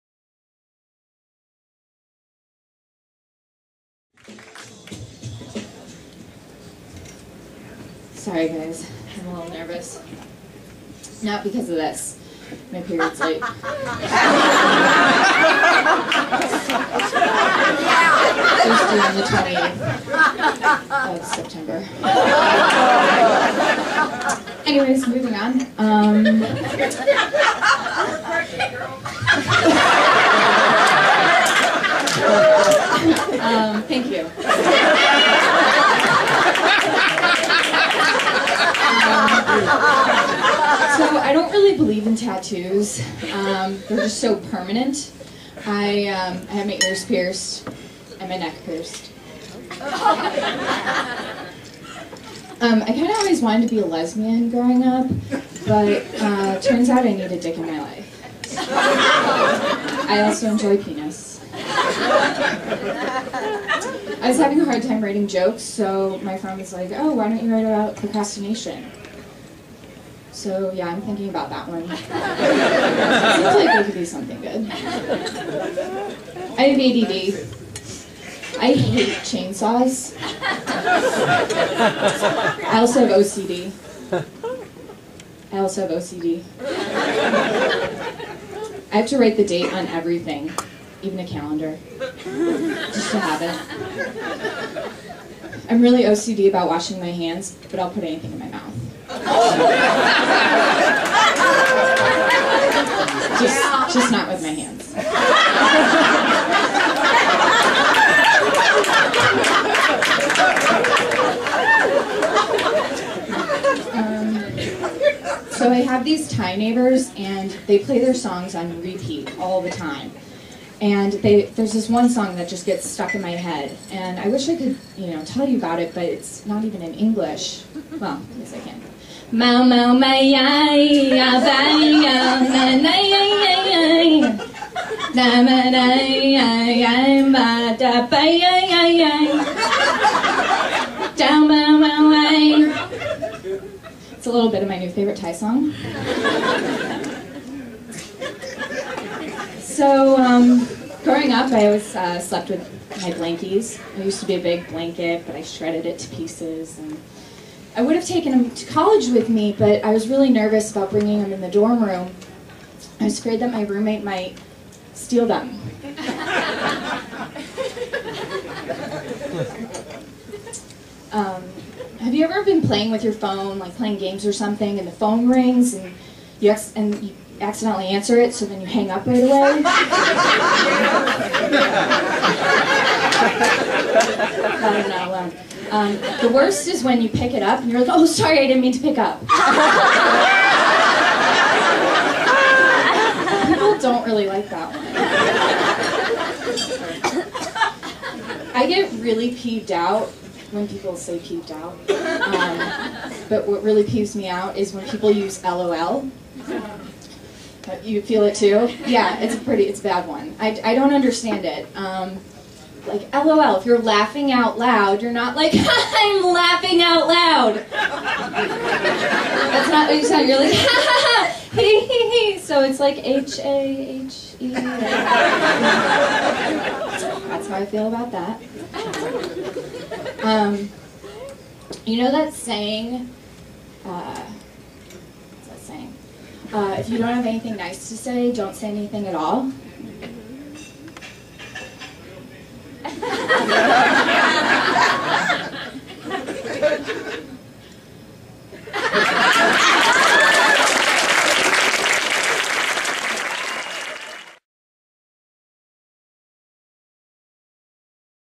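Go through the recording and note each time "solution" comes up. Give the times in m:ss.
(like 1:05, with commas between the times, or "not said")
not said.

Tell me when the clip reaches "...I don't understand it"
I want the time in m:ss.
3:30.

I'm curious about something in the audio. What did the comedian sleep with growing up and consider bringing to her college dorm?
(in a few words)
Blankies.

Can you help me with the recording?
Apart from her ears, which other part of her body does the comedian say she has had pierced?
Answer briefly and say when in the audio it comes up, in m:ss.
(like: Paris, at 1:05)
Neck, at 0:48.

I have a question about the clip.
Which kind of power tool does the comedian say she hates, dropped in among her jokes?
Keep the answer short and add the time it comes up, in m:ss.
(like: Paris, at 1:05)
Chainsaws, at 1:19.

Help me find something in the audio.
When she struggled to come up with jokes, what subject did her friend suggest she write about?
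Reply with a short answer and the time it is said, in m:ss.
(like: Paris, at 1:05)
Procrastination, at 1:07.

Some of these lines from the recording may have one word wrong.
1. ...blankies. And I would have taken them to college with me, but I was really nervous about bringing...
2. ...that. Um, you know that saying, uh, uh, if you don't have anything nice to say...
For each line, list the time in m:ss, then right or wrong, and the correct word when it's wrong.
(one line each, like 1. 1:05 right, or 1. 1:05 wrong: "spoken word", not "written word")
1. 2:36 wrong: "pieces", not "blankies"
2. 3:48 right.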